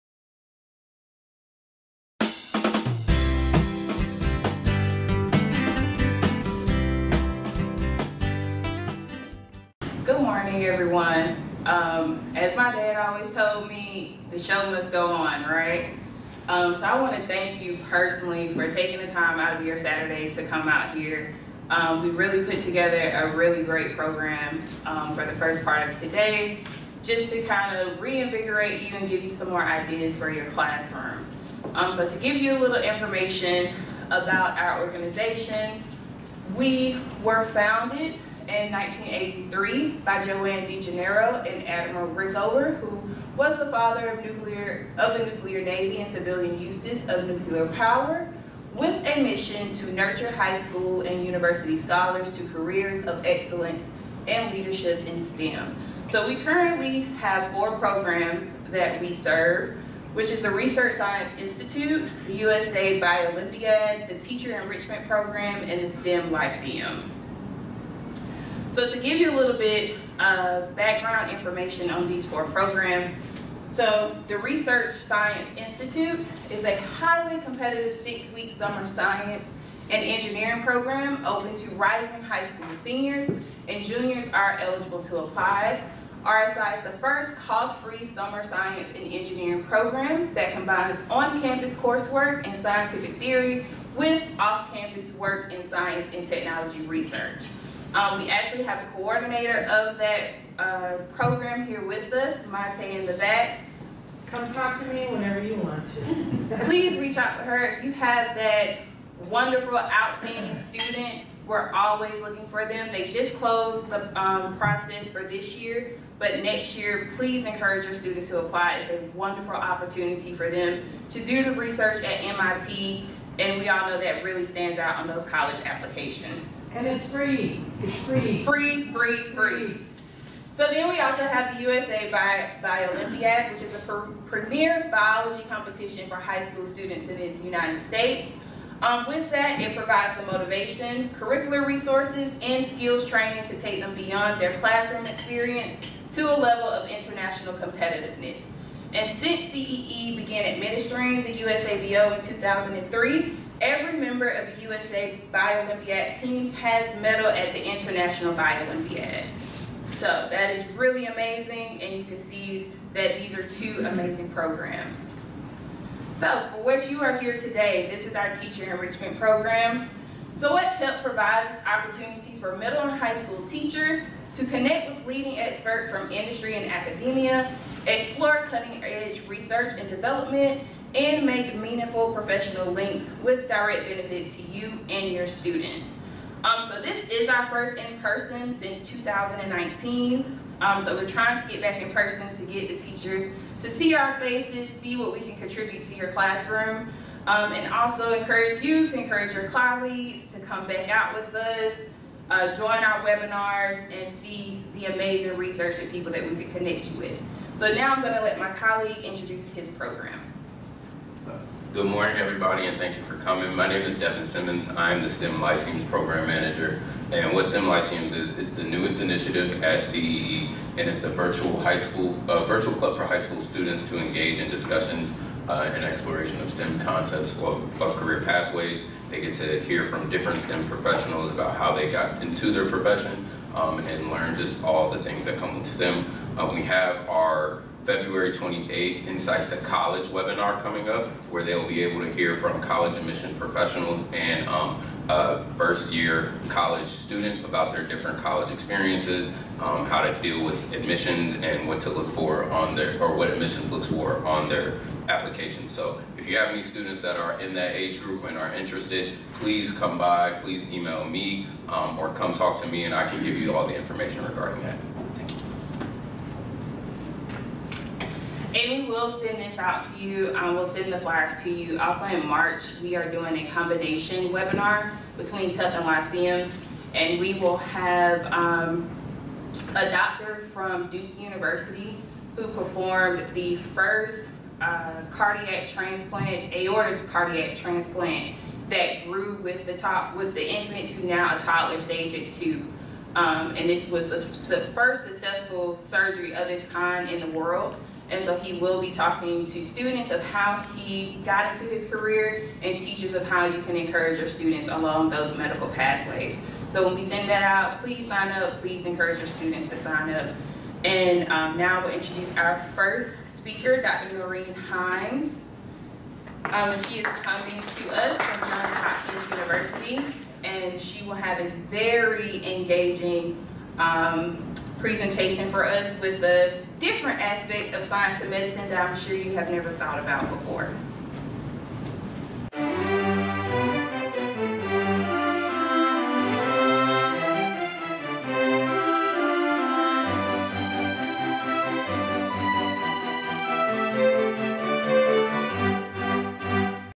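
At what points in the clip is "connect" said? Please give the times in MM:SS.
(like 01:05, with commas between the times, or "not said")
02:54, 03:26.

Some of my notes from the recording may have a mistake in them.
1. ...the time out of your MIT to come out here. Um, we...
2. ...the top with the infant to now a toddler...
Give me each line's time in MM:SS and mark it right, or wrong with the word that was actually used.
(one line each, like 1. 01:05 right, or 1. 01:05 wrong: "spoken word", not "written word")
1. 00:19 wrong: "Saturday", not "MIT"
2. 04:49 right.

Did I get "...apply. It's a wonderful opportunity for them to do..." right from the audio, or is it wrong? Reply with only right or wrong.
right.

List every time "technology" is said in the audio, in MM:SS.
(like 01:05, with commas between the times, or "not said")
01:36.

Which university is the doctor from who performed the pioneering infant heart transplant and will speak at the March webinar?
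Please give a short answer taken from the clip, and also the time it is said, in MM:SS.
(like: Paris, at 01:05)
Duke University, at 04:40.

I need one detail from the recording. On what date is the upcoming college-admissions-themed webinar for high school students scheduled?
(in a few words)
February 28.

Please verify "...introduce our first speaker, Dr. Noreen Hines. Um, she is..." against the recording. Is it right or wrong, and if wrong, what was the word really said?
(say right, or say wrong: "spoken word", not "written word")
right.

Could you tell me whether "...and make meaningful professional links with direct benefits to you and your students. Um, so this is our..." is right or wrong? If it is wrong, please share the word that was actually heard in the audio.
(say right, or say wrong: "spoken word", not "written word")
right.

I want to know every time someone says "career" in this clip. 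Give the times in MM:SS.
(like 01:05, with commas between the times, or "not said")
00:52, 03:47, 05:01.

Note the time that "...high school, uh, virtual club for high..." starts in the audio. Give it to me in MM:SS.
03:41.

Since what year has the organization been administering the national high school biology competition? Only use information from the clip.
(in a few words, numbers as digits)
2003.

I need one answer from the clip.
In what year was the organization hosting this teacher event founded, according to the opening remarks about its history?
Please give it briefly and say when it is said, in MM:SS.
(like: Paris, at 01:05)
1983, at 00:38.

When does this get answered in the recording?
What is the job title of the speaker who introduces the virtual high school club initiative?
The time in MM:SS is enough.
03:35.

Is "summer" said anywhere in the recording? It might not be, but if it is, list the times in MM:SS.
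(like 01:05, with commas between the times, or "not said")
01:18, 01:28.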